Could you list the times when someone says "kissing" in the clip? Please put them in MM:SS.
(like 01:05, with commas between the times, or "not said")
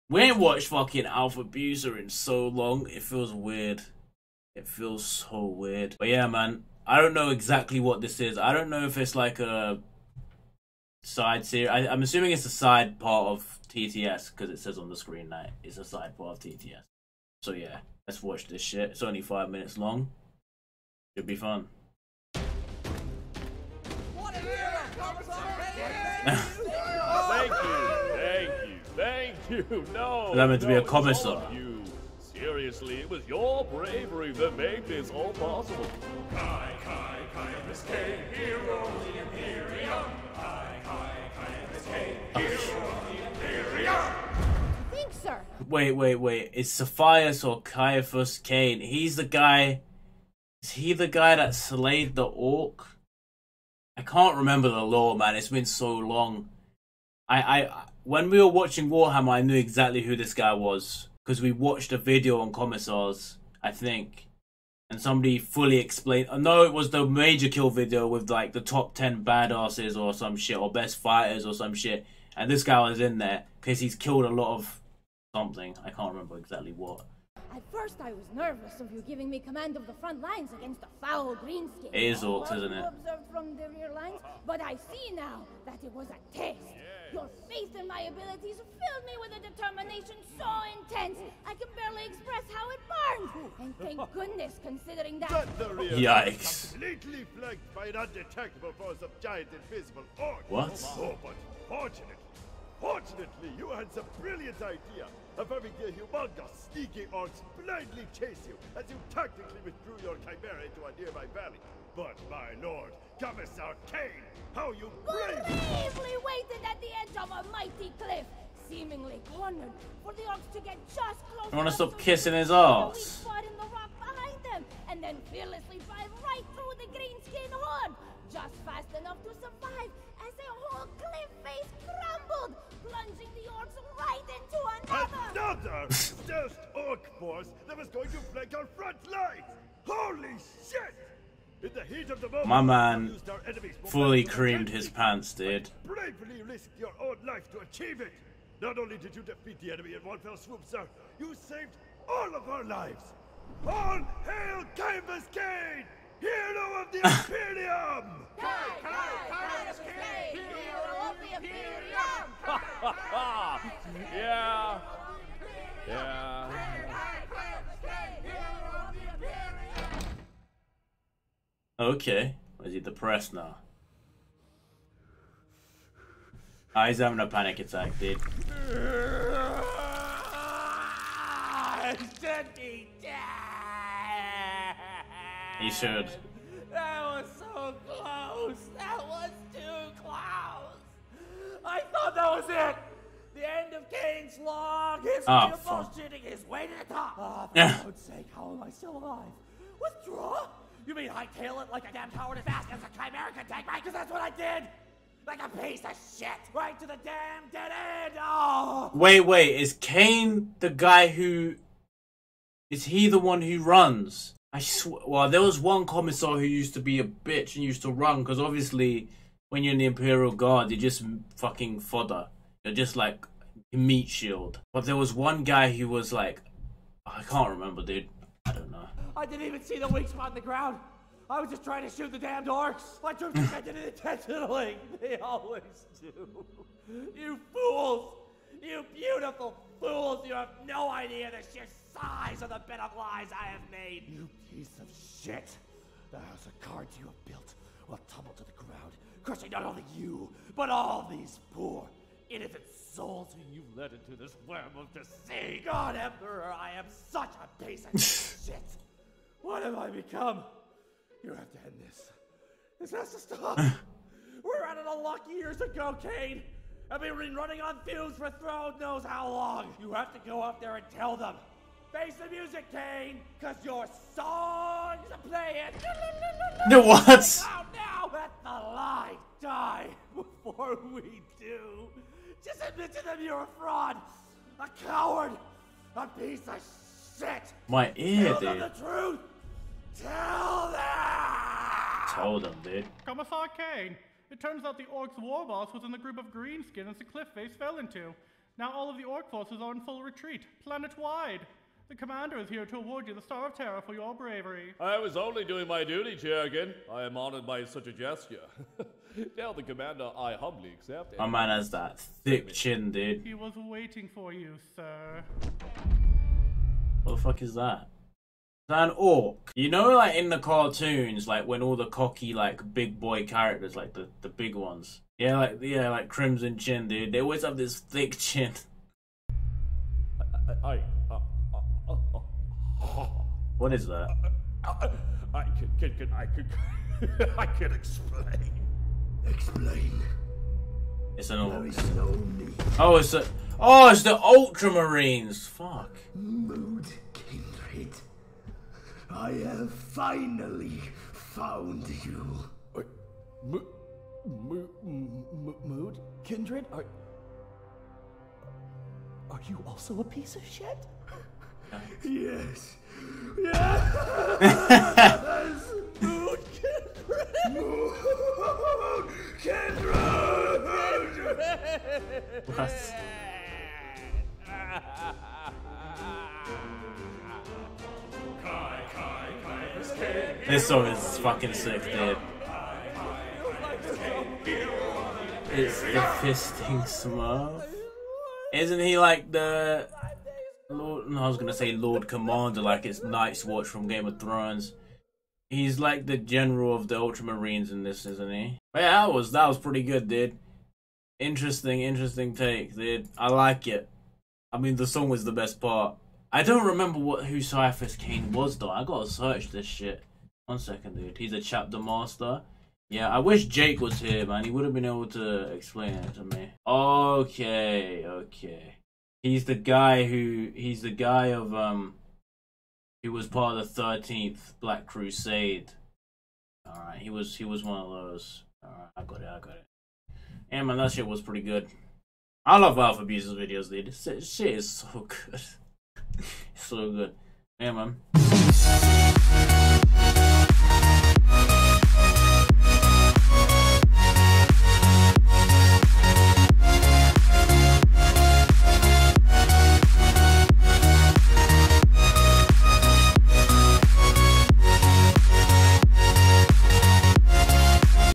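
02:01.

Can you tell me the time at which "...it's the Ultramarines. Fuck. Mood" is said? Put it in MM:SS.
05:43.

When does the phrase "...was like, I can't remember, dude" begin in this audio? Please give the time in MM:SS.
03:45.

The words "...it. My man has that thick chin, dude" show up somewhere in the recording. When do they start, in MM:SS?
05:11.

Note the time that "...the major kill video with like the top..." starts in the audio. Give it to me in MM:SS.
01:06.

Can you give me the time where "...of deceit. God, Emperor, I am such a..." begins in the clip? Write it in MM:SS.
04:14.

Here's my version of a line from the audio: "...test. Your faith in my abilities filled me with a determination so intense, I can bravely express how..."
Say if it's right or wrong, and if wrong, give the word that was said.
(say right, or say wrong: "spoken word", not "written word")
wrong: "barely", not "bravely".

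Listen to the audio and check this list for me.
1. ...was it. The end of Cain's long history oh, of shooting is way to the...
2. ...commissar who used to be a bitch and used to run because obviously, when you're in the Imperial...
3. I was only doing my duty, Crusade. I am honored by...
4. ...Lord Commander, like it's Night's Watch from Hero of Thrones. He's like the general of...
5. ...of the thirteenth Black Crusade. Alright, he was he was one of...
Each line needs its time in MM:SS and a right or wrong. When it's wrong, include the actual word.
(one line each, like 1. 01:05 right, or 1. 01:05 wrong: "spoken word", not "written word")
1. 03:12 right
2. 03:35 right
3. 05:04 wrong: "Jurgen", not "Crusade"
4. 06:31 wrong: "Game", not "Hero"
5. 07:03 right.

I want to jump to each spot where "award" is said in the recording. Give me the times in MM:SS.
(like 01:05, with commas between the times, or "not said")
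05:02.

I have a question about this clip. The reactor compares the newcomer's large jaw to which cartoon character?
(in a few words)
Crimson Chin.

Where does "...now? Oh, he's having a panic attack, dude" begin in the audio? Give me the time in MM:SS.
02:53.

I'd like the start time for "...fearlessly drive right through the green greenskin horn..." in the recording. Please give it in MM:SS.
02:05.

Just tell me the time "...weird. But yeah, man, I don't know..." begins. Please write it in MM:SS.
00:05.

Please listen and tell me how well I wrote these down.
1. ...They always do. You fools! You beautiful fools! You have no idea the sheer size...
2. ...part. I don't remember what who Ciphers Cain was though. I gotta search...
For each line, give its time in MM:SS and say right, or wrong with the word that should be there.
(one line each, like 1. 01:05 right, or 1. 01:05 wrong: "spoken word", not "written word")
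1. 03:55 right
2. 06:45 right.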